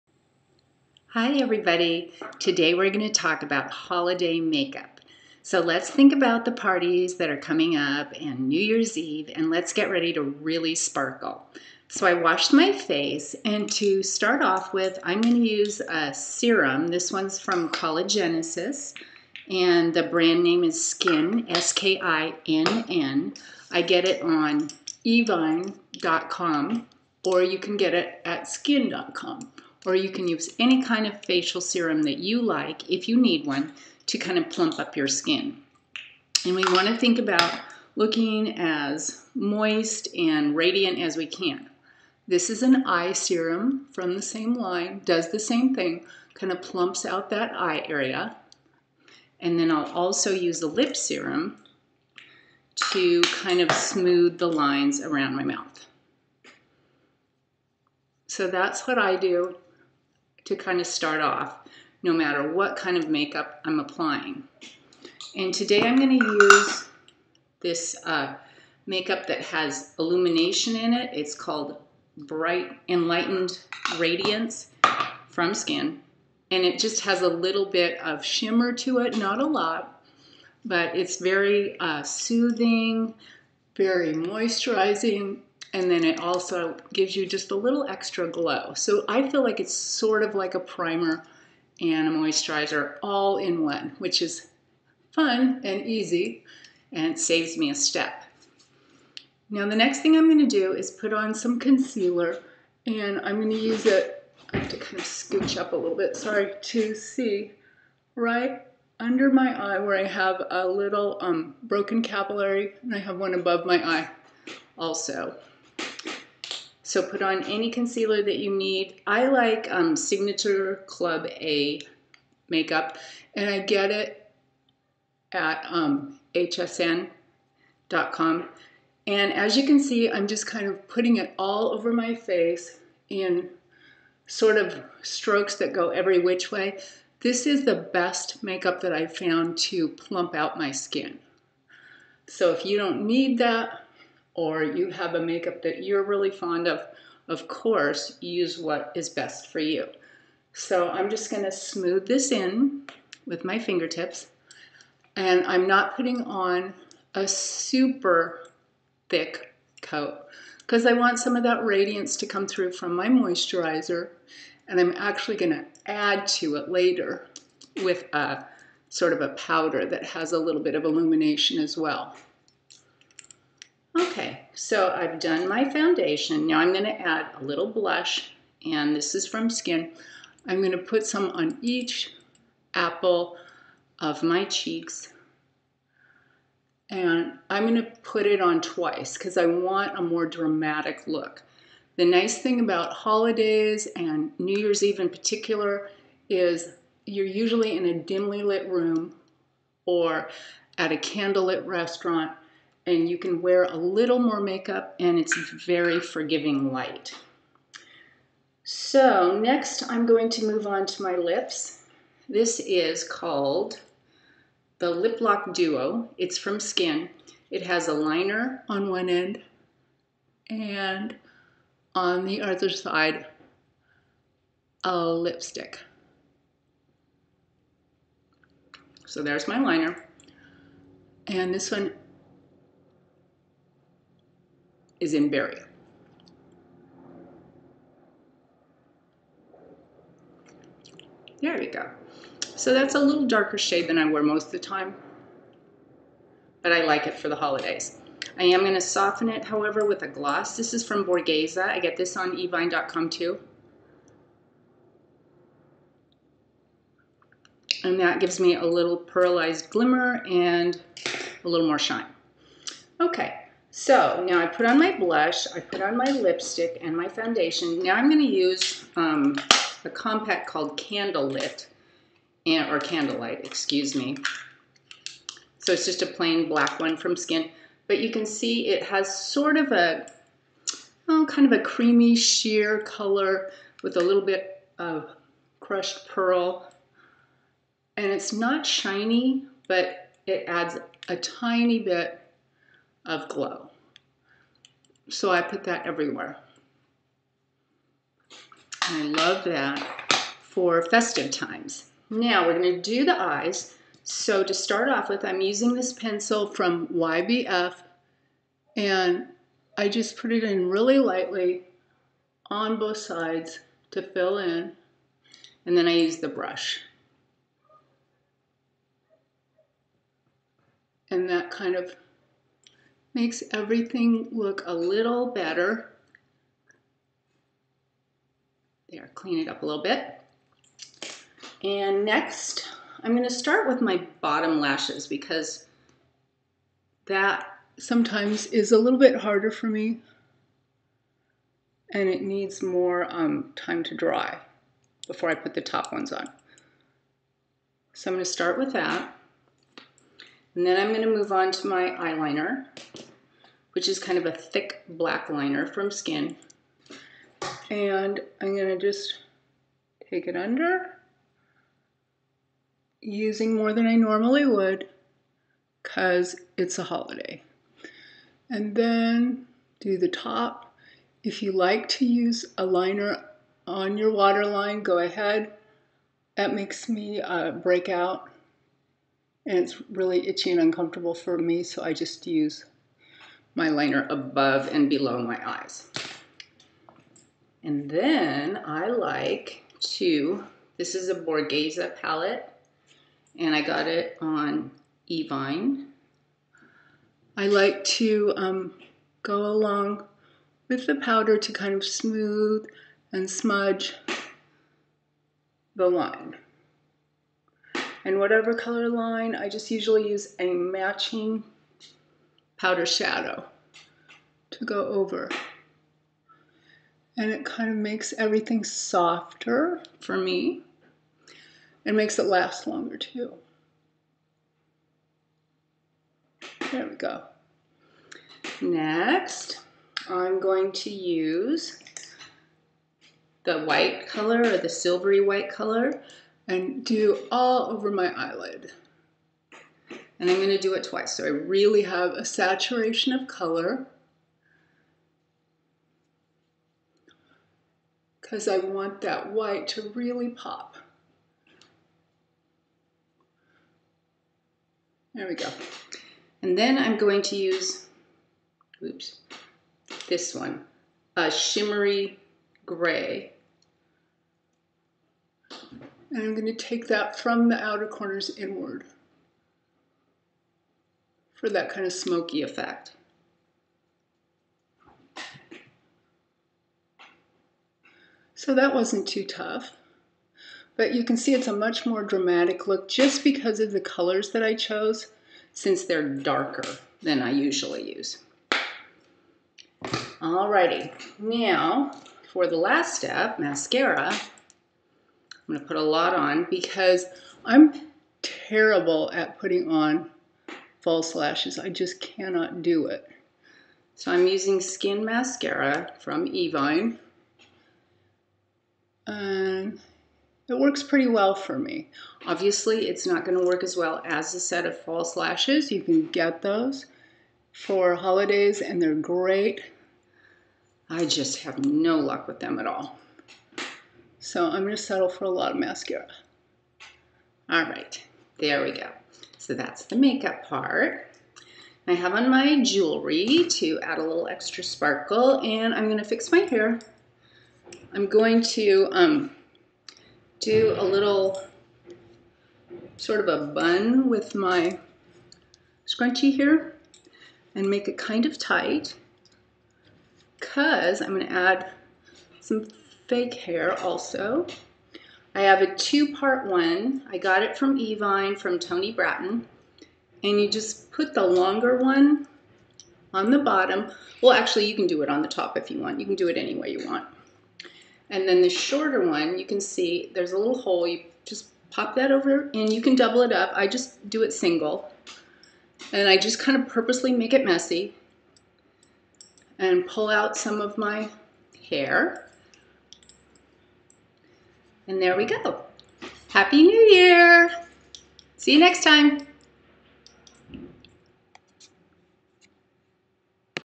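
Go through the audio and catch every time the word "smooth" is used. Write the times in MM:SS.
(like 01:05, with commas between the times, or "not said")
00:53, 02:31, 06:41.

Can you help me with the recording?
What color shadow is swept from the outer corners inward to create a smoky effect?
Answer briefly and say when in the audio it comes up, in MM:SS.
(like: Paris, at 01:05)
shimmery gray, at 07:41.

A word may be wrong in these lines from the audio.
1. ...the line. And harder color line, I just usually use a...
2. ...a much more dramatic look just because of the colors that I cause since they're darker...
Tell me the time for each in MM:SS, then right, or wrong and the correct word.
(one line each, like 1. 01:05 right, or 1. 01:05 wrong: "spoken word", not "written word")
1. 06:45 wrong: "whatever", not "harder"
2. 08:01 wrong: "chose", not "cause".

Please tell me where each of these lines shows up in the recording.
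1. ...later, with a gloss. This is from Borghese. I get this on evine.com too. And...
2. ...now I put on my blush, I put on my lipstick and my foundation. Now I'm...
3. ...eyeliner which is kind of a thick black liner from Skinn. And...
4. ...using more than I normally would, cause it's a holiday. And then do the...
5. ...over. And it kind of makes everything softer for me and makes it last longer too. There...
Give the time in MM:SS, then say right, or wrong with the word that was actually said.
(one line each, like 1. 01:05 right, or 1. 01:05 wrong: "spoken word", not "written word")
1. 04:09 wrong: "however", not "later"
2. 04:24 right
3. 05:51 right
4. 06:03 right
5. 06:54 right.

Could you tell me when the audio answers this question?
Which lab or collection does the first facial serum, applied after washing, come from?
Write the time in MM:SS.
00:17.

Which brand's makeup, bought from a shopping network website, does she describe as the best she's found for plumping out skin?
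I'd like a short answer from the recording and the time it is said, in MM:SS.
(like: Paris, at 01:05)
Signature Club A, at 01:59.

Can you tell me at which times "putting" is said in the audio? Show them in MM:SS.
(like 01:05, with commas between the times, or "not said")
02:10, 02:35, 08:19.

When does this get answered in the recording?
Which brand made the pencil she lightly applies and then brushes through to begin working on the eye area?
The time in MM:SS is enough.
05:06.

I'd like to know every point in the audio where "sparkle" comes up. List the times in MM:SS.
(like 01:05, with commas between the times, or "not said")
00:10, 08:54.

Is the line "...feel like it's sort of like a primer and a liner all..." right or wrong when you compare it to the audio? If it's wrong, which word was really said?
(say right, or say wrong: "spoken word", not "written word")
wrong: "moisturizer", not "liner".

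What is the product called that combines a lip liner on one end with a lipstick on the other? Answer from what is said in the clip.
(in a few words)
Lip Lock Duo.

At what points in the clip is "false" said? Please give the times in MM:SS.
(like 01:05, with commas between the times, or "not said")
08:20, 08:34.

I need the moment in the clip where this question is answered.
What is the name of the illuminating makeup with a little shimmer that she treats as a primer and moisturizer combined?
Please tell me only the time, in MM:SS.
01:12.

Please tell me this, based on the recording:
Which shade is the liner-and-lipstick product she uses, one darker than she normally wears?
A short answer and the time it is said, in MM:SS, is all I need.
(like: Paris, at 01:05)
berry, at 03:55.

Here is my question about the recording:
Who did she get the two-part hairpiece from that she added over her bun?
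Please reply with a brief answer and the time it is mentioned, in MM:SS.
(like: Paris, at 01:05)
Toni Brattin, at 09:18.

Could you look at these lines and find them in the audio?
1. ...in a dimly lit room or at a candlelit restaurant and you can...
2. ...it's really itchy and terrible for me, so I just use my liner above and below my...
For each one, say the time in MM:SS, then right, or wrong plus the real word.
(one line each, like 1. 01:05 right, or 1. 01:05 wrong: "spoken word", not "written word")
1. 03:17 right
2. 06:19 wrong: "uncomfortable", not "terrible".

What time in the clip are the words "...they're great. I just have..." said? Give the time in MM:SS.
08:38.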